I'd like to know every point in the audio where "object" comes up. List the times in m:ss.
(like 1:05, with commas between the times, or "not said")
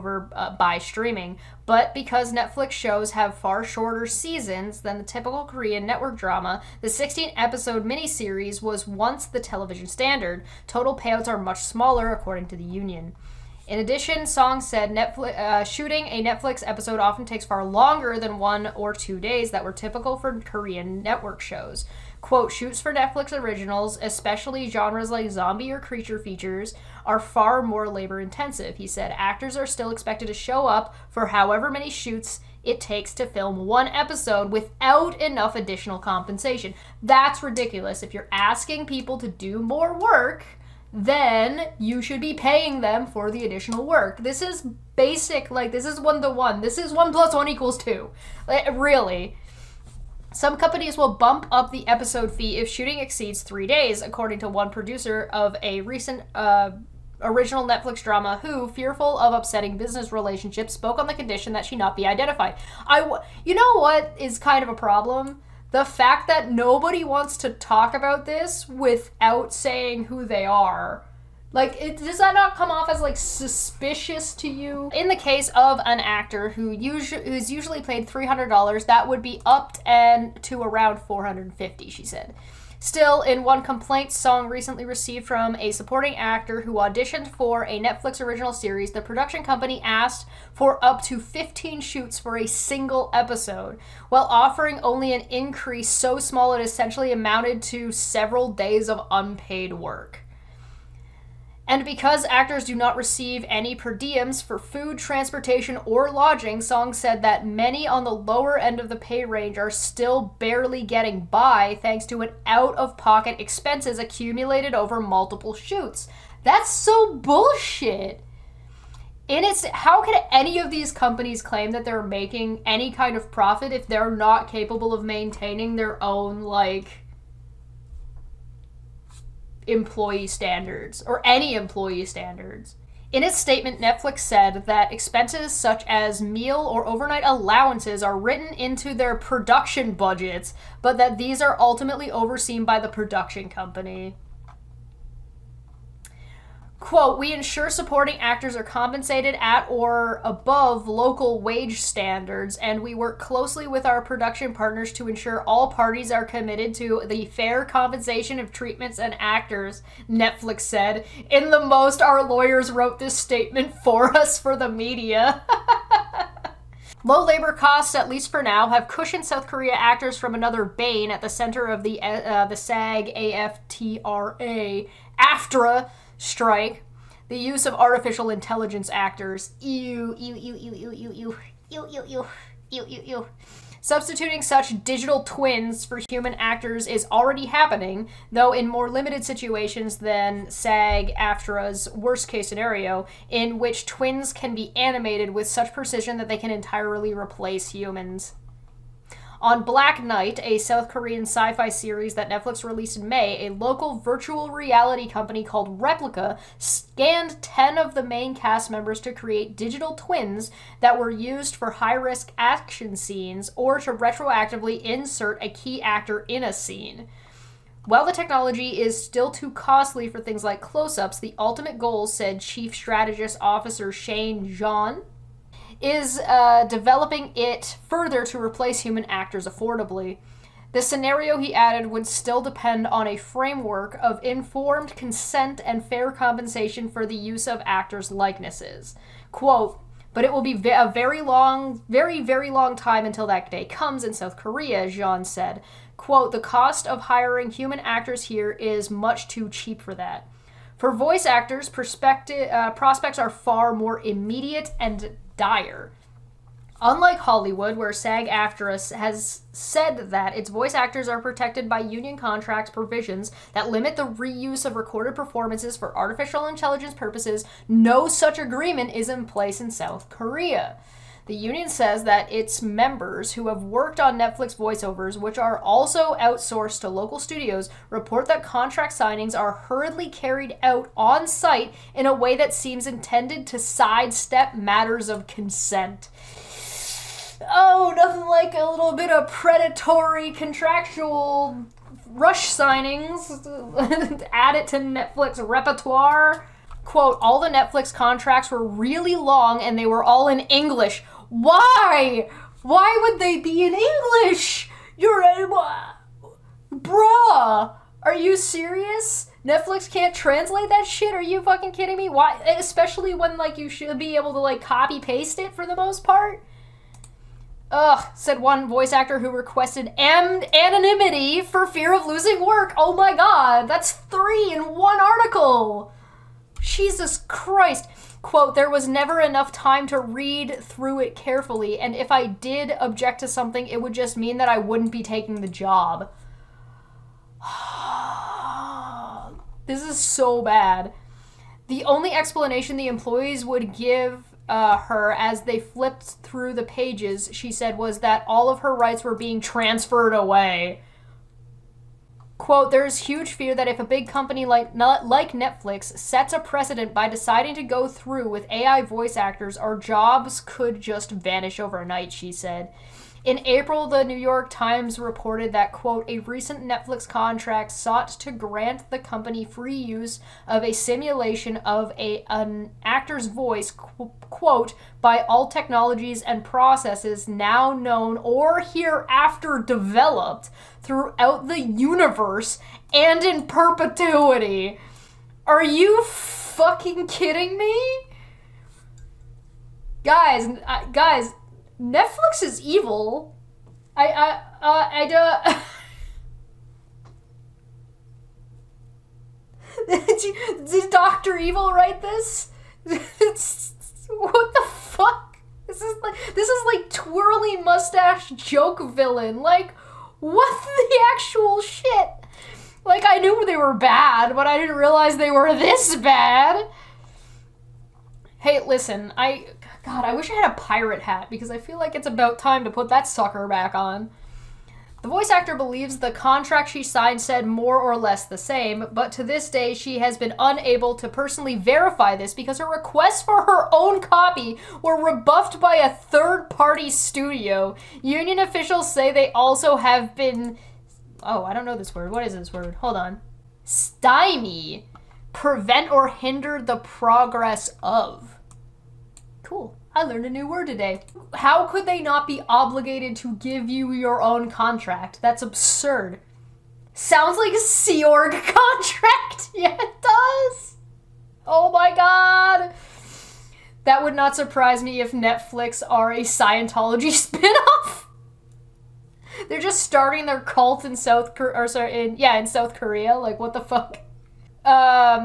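5:32.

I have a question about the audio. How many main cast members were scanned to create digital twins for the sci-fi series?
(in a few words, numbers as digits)
10.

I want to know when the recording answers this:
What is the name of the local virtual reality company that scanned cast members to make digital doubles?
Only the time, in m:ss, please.
3:25.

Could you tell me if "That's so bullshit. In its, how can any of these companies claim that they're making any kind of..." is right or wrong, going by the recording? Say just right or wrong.
right.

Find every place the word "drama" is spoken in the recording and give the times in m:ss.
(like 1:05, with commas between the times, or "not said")
0:06, 0:58.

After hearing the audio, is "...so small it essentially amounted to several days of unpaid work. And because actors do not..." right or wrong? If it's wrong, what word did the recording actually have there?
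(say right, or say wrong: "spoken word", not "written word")
right.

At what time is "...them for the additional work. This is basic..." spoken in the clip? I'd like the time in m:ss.
0:42.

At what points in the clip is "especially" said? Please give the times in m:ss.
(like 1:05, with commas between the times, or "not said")
0:24, 5:12.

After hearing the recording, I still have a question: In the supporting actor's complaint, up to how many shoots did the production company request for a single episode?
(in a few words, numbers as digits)
15.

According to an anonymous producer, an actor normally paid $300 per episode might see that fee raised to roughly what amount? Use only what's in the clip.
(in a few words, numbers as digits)
$450.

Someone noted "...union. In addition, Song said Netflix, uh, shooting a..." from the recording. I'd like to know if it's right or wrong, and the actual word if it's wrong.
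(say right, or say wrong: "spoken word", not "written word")
right.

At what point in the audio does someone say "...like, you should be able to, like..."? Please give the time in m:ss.
5:13.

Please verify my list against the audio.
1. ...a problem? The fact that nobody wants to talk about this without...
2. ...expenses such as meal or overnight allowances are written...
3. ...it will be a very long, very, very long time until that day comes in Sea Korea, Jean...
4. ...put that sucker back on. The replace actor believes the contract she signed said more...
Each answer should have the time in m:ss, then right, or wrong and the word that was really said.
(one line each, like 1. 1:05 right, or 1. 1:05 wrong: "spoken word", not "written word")
1. 1:04 right
2. 2:14 right
3. 4:00 wrong: "South", not "Sea"
4. 7:02 wrong: "voice", not "replace".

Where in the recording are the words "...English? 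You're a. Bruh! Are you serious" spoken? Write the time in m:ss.
5:03.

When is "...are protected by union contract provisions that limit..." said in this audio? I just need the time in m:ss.
4:21.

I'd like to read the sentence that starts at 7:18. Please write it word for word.
Union officials say they also have been.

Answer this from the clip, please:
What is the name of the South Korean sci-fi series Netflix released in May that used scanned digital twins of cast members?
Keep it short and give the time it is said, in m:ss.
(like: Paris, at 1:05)
Black Knight, at 3:19.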